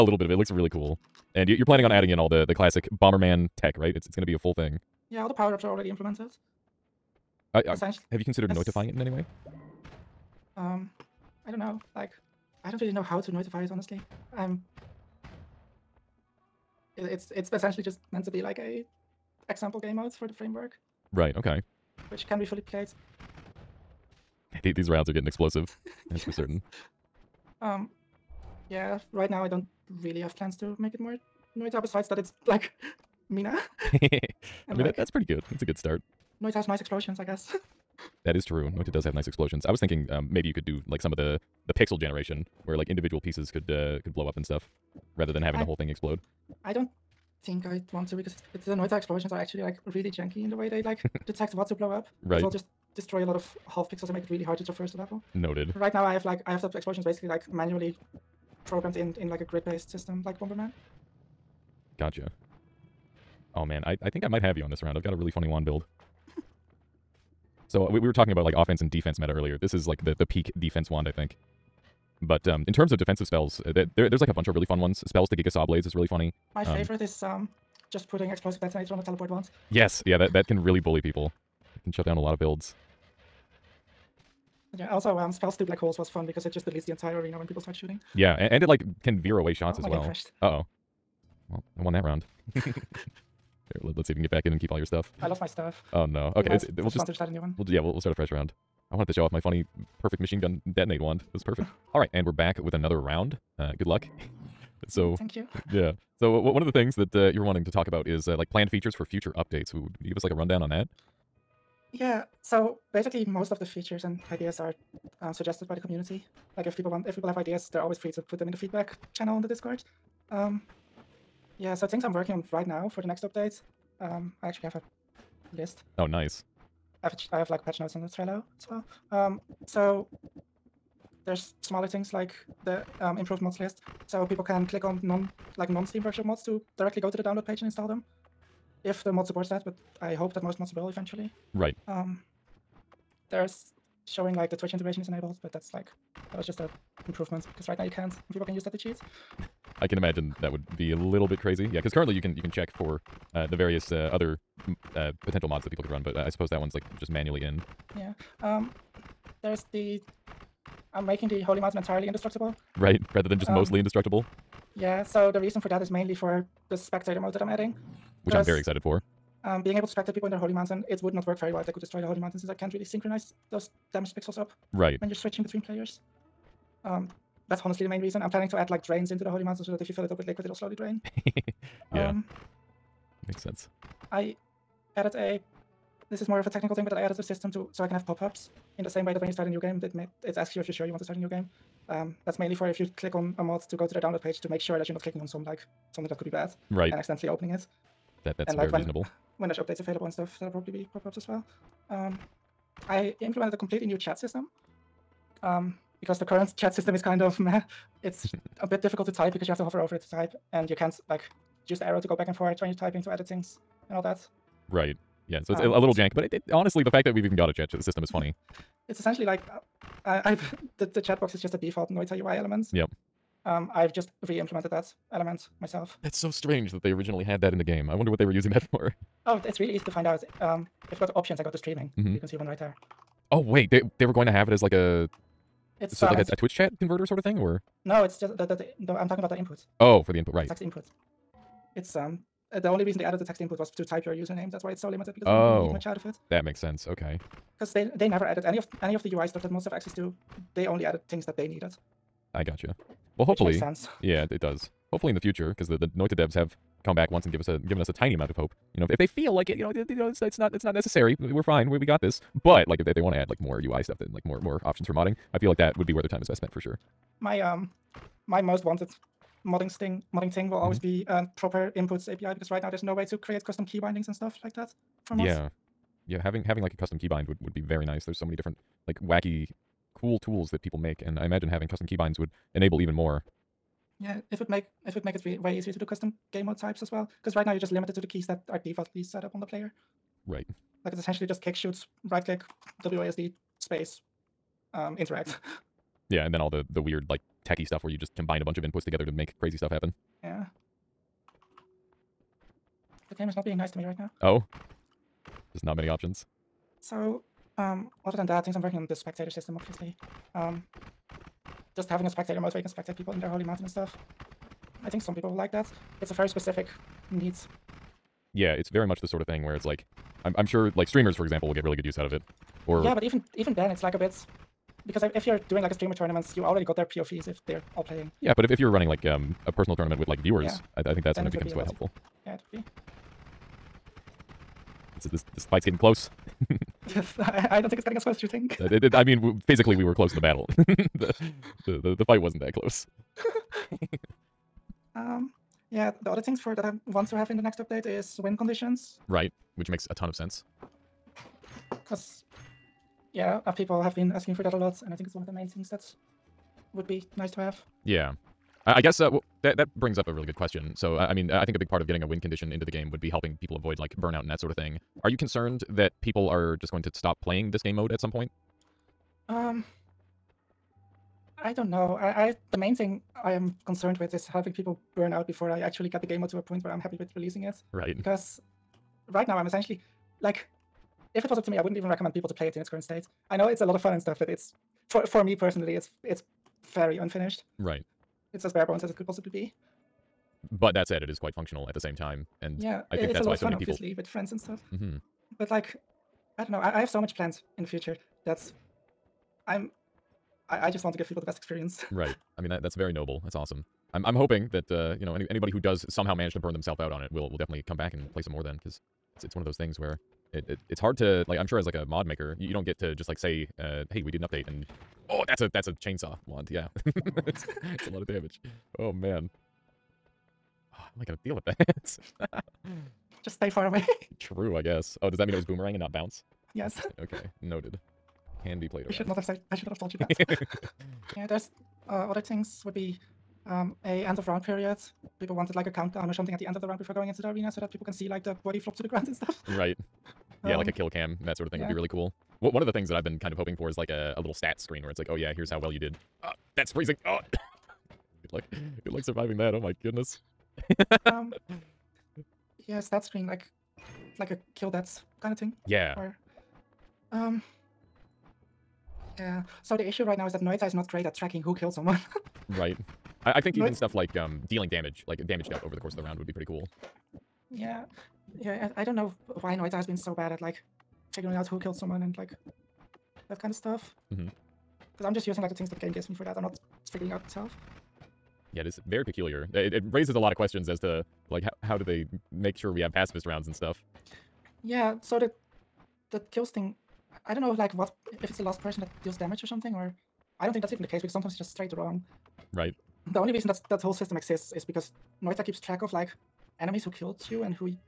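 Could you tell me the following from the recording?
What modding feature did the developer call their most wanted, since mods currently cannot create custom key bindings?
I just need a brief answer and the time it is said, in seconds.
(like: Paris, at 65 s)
proper inputs API, at 271 s.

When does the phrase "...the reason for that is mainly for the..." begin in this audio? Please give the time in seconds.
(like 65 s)
165 s.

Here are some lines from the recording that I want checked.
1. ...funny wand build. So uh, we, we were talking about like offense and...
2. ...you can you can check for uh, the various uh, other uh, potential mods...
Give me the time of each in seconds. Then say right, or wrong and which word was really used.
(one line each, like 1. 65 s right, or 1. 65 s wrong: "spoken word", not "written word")
1. 65 s right
2. 152 s right.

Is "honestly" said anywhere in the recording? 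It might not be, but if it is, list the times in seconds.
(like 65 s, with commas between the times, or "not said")
13 s, 177 s, 216 s.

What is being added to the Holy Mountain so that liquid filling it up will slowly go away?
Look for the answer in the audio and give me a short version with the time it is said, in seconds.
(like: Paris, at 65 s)
drains, at 178 s.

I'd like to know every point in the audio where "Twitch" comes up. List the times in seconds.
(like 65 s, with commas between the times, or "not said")
144 s, 236 s.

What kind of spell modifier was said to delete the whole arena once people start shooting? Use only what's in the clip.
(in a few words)
spells to black holes.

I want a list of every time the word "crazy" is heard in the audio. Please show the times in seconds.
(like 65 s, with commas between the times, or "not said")
151 s, 299 s.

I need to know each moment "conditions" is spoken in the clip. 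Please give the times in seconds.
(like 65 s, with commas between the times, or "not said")
348 s, 362 s.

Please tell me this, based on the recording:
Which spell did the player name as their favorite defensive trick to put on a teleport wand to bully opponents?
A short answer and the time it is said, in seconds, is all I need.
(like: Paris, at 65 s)
explosive detonator, at 78 s.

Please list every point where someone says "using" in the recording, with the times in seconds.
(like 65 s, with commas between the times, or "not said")
228 s, 475 s.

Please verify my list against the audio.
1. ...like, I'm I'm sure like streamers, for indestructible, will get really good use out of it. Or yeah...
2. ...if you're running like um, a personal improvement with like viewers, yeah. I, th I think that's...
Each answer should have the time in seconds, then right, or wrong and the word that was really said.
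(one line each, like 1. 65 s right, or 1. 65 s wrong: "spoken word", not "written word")
1. 319 s wrong: "example", not "indestructible"
2. 328 s wrong: "tournament", not "improvement".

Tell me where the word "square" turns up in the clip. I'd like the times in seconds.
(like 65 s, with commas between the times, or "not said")
not said.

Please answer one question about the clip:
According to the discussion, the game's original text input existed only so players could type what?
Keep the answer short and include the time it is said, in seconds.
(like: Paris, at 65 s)
username, at 244 s.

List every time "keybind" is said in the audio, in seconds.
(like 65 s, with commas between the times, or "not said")
276 s, 281 s.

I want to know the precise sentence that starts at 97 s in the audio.
We'll yeah, we'll we'll start a fresh round.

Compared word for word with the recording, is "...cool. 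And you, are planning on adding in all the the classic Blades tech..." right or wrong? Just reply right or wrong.
wrong.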